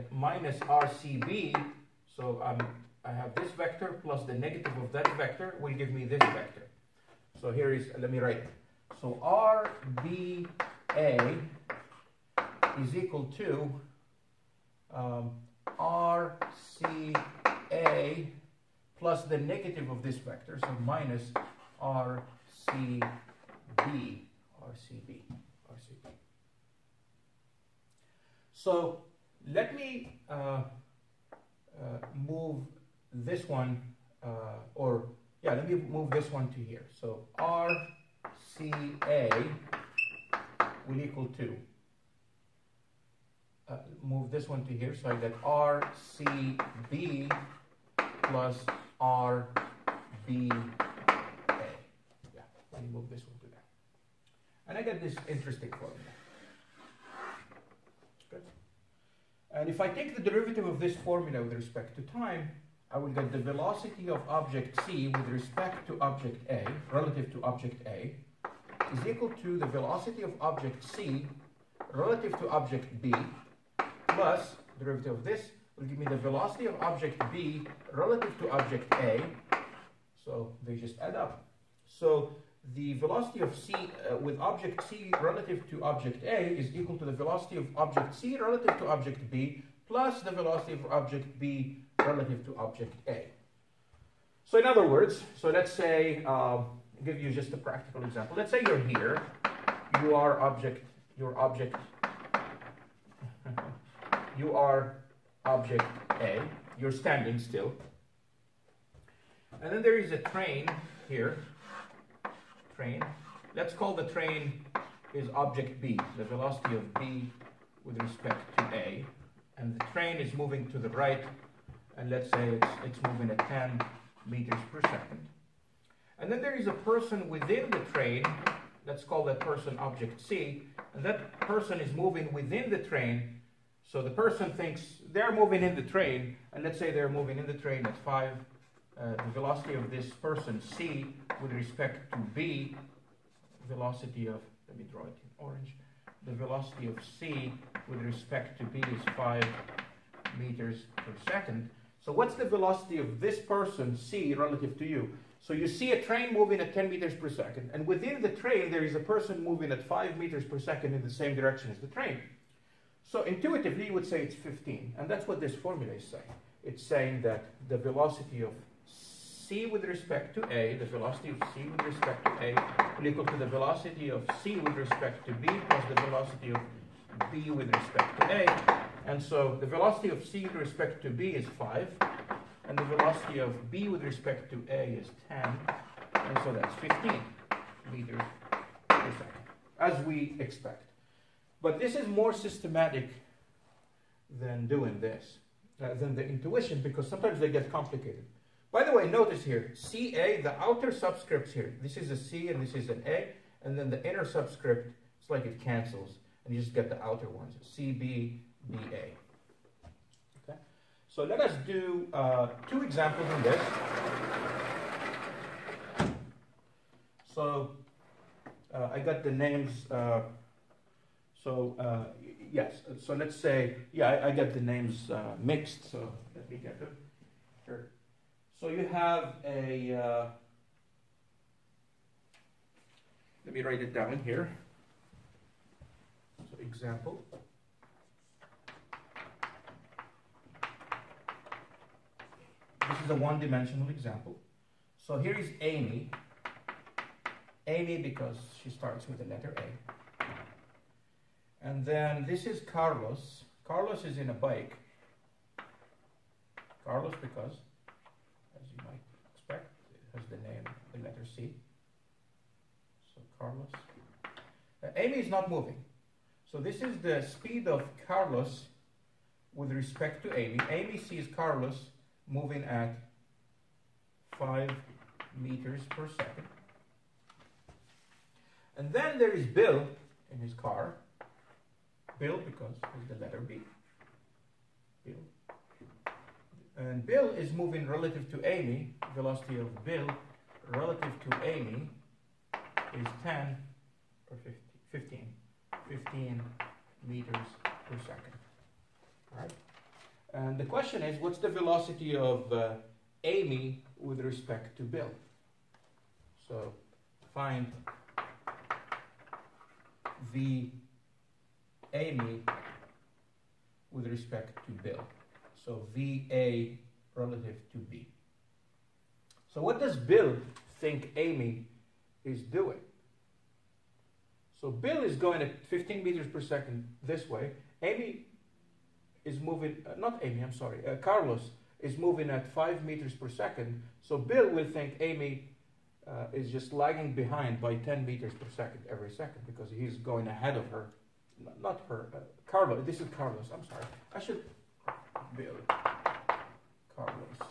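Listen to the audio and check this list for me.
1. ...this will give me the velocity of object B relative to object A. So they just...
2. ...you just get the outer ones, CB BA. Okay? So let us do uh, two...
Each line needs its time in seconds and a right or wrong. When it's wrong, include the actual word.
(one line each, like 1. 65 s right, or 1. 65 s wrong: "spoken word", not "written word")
1. 75 s right
2. 206 s right.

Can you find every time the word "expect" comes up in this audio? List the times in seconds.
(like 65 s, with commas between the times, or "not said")
190 s, 259 s.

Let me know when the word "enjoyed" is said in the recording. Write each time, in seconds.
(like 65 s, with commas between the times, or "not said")
not said.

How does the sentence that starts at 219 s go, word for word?
Uh, so uh, yes, so let's say, yeah, I, I got the names uh, mixed.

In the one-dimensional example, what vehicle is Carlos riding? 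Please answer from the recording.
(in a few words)
a bike.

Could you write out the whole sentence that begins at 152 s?
So what's the velocity of this person, C, relative to you?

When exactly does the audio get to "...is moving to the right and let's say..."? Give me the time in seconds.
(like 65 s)
120 s.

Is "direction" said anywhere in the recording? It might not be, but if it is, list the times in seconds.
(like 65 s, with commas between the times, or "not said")
161 s.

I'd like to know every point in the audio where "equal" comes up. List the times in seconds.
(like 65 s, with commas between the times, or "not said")
12 s, 41 s, 69 s, 86 s, 173 s.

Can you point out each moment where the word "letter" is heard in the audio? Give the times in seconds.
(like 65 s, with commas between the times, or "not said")
249 s, 261 s, 283 s.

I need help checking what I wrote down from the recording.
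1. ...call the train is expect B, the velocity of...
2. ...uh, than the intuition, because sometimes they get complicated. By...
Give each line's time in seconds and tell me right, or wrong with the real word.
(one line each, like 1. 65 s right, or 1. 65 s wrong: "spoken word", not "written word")
1. 113 s wrong: "object", not "expect"
2. 195 s right.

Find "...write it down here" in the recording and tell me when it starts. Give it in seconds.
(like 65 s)
233 s.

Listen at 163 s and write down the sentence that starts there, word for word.
So intuitively you would say it's 15, and that's what this formula is saying.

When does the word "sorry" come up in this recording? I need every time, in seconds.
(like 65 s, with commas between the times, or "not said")
330 s, 343 s.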